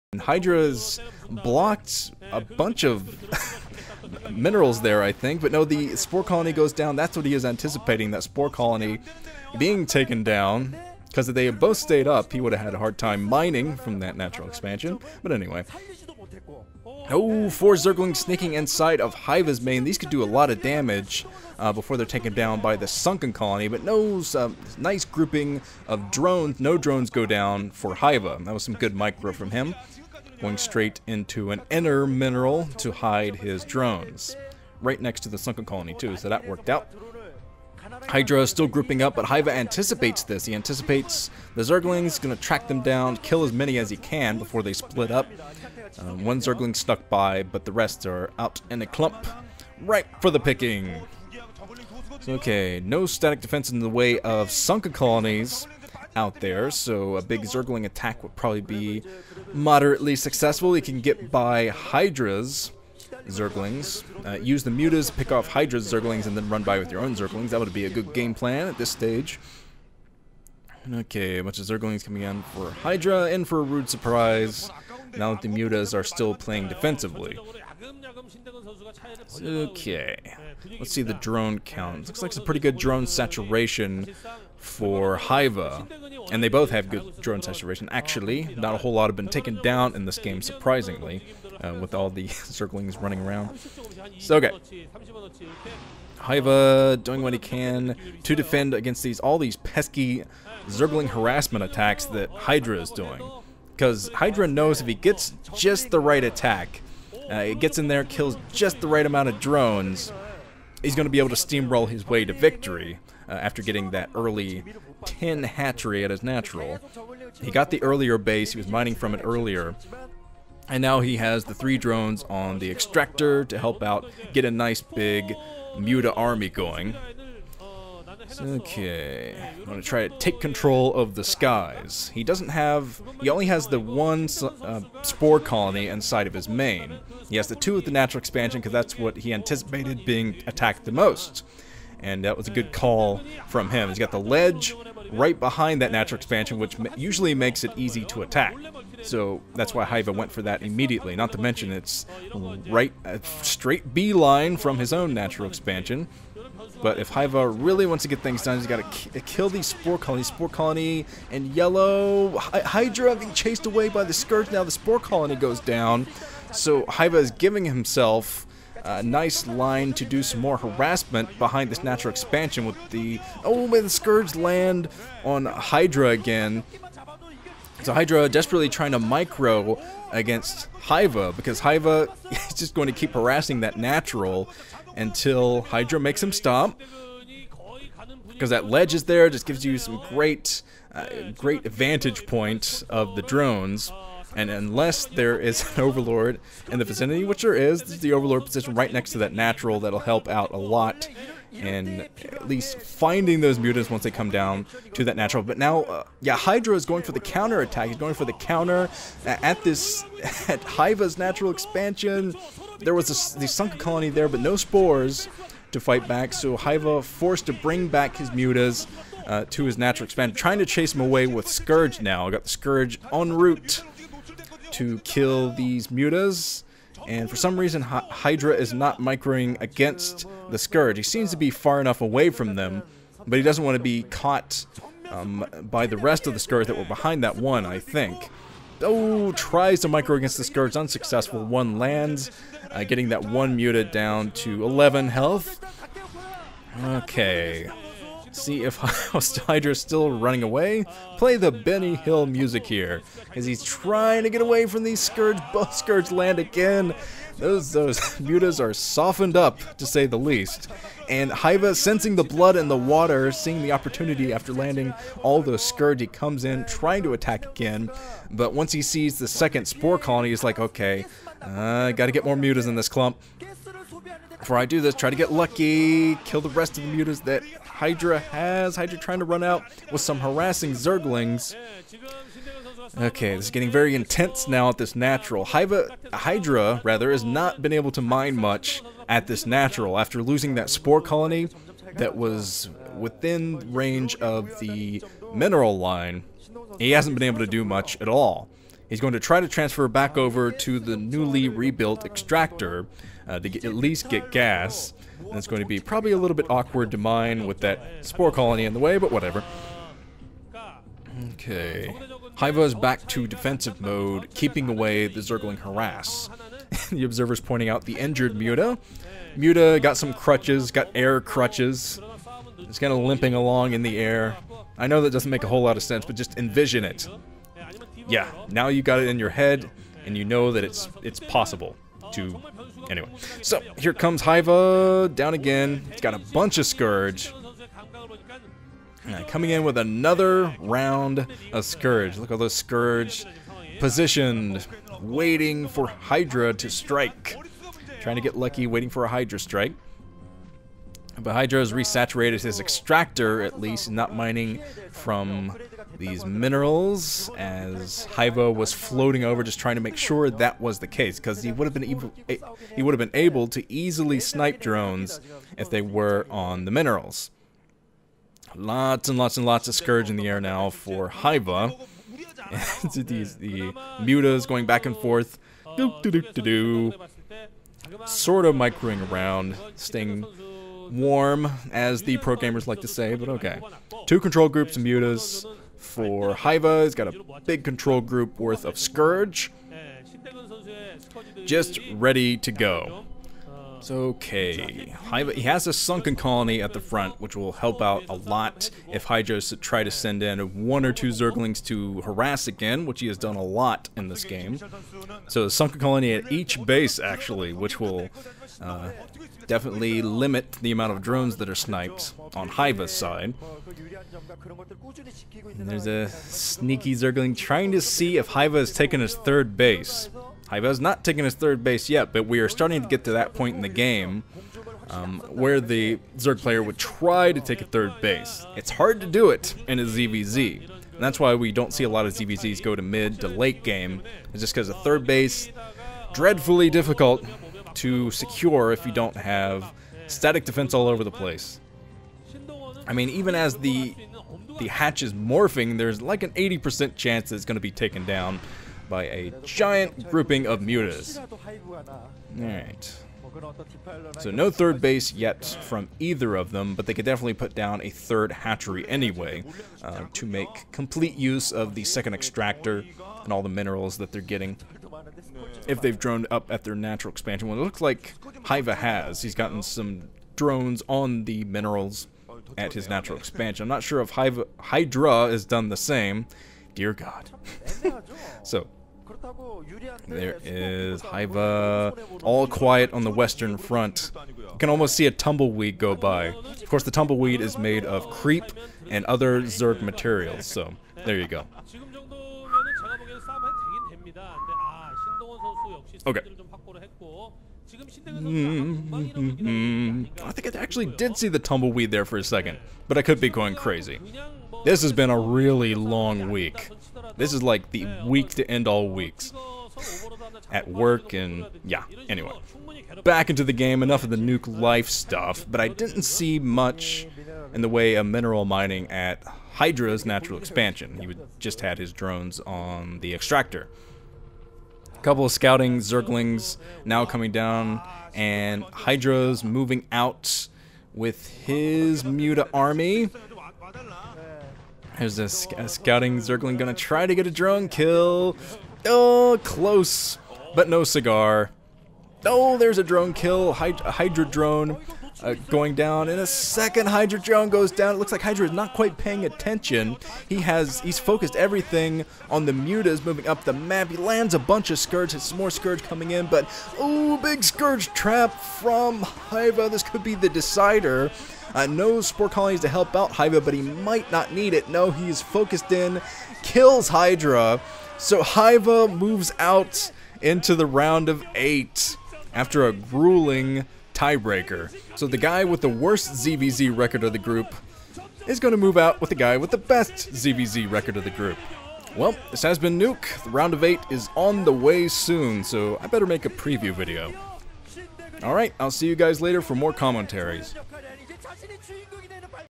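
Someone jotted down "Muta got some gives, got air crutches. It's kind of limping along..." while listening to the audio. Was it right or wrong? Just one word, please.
wrong.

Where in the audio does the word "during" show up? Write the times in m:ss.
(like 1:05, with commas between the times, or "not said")
not said.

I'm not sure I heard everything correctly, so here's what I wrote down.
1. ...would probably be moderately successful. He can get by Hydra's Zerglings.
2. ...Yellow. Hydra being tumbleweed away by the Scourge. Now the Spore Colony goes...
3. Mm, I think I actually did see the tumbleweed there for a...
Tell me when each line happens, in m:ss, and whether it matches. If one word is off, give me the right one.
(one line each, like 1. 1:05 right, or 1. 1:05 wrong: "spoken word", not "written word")
1. 0:58 right
2. 2:41 wrong: "chased", not "tumbleweed"
3. 8:18 right.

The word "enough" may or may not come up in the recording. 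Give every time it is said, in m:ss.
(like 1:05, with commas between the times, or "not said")
3:51, 8:33.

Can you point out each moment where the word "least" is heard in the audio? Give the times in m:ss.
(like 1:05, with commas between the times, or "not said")
3:22, 4:20, 5:03, 5:53.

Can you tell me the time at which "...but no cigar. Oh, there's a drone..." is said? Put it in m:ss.
9:00.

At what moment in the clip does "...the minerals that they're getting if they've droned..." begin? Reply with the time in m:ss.
7:43.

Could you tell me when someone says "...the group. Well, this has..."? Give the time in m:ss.
9:41.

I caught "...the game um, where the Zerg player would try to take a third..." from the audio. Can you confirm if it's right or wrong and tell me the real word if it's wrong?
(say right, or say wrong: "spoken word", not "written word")
right.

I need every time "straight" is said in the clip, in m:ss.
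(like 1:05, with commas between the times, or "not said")
0:30, 2:33.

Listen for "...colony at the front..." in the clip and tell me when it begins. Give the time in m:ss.
6:36.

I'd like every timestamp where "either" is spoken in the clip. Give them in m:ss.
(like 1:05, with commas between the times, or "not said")
7:35.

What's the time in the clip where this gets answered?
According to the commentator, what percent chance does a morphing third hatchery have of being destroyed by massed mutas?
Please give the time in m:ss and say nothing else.
7:26.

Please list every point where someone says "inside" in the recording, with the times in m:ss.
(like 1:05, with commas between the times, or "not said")
0:18, 2:15.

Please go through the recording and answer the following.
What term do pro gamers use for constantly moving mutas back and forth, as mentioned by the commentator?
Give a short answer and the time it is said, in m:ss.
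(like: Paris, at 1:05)
staying warm, at 6:19.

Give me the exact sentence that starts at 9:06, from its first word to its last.
In a second, Hydra drone goes down.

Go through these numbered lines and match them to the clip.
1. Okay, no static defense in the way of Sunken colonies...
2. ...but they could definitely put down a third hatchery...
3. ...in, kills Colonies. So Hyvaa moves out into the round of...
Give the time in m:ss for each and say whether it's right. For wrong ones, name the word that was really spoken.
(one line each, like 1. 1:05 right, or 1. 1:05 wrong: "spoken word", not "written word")
1. 0:52 right
2. 7:36 right
3. 9:25 wrong: "Hydra", not "Colonies".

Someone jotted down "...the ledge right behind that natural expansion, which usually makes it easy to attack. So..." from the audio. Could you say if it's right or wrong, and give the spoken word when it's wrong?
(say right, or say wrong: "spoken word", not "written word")
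right.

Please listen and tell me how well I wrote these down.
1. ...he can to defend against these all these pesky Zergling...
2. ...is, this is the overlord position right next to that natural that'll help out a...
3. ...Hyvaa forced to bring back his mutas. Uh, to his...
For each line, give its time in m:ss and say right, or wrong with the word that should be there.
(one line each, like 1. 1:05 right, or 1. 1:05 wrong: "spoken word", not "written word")
1. 1:37 right
2. 3:17 right
3. 3:36 right.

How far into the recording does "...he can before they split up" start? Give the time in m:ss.
0:43.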